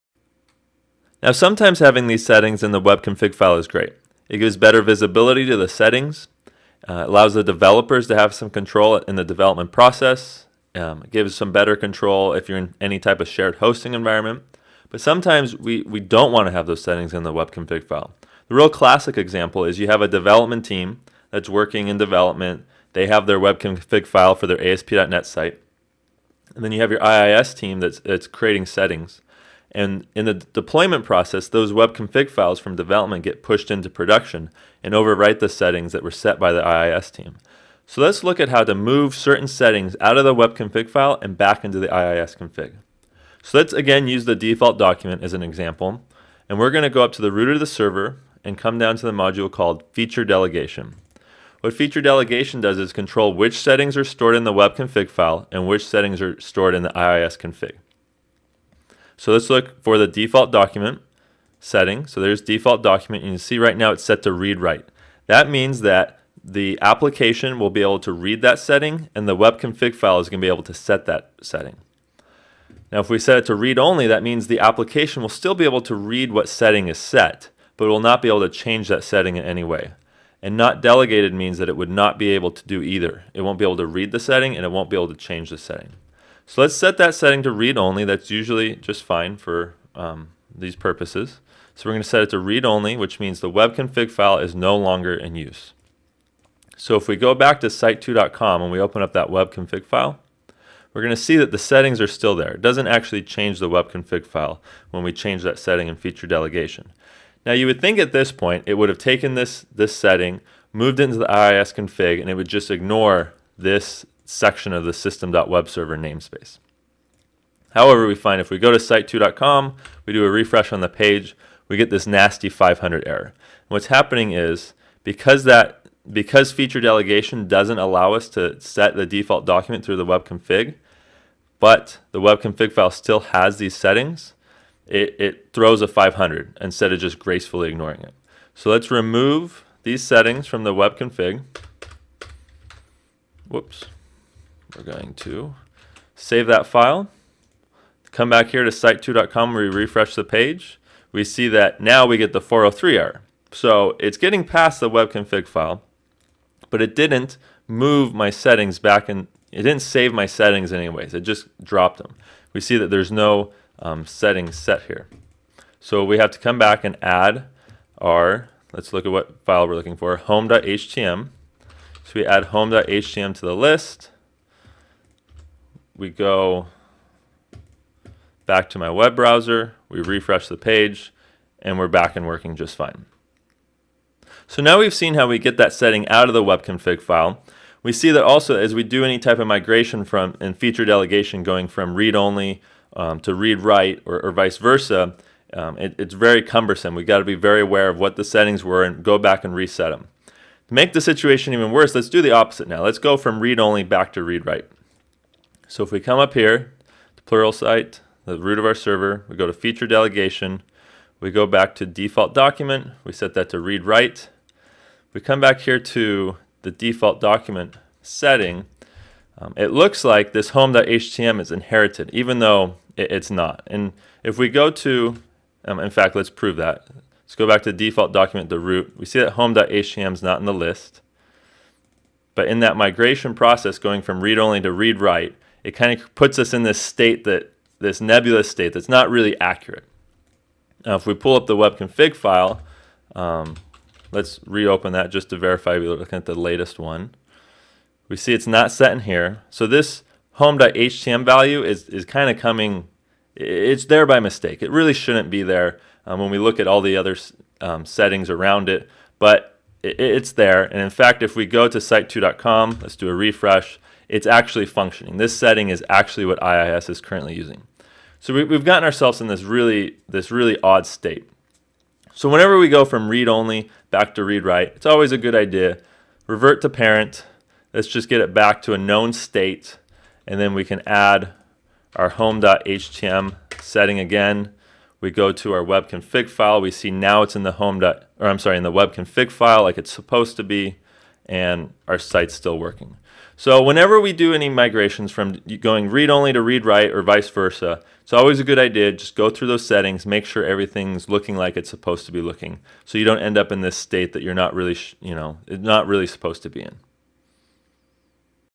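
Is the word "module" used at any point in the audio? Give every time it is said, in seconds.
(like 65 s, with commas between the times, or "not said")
49 s.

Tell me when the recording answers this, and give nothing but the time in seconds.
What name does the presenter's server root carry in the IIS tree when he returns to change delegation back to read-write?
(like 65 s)
207 s.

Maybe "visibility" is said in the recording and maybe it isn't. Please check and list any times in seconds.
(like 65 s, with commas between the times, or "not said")
4 s.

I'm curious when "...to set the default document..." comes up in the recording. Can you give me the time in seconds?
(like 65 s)
128 s.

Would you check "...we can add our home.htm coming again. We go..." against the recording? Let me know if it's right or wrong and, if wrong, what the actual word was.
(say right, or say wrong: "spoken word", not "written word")
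wrong: "setting", not "coming".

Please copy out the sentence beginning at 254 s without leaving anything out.
It really shouldn't be there um, when we look at all the other um, settings around it, but it, it's there.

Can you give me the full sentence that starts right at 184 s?
So now we've seen how we get that setting out of the web config file.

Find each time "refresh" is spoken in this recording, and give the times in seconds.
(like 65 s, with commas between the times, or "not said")
120 s, 149 s, 180 s, 263 s.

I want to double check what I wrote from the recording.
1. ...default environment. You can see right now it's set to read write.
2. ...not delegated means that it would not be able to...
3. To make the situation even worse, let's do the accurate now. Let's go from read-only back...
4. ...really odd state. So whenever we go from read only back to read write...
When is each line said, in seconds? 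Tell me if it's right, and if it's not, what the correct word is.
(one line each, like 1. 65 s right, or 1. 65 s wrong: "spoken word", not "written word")
1. 62 s wrong: "document", not "environment"
2. 80 s right
3. 200 s wrong: "opposite", not "accurate"
4. 270 s right.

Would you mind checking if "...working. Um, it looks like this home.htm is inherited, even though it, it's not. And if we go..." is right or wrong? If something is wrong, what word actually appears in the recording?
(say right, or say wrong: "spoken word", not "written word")
wrong: "setting", not "working".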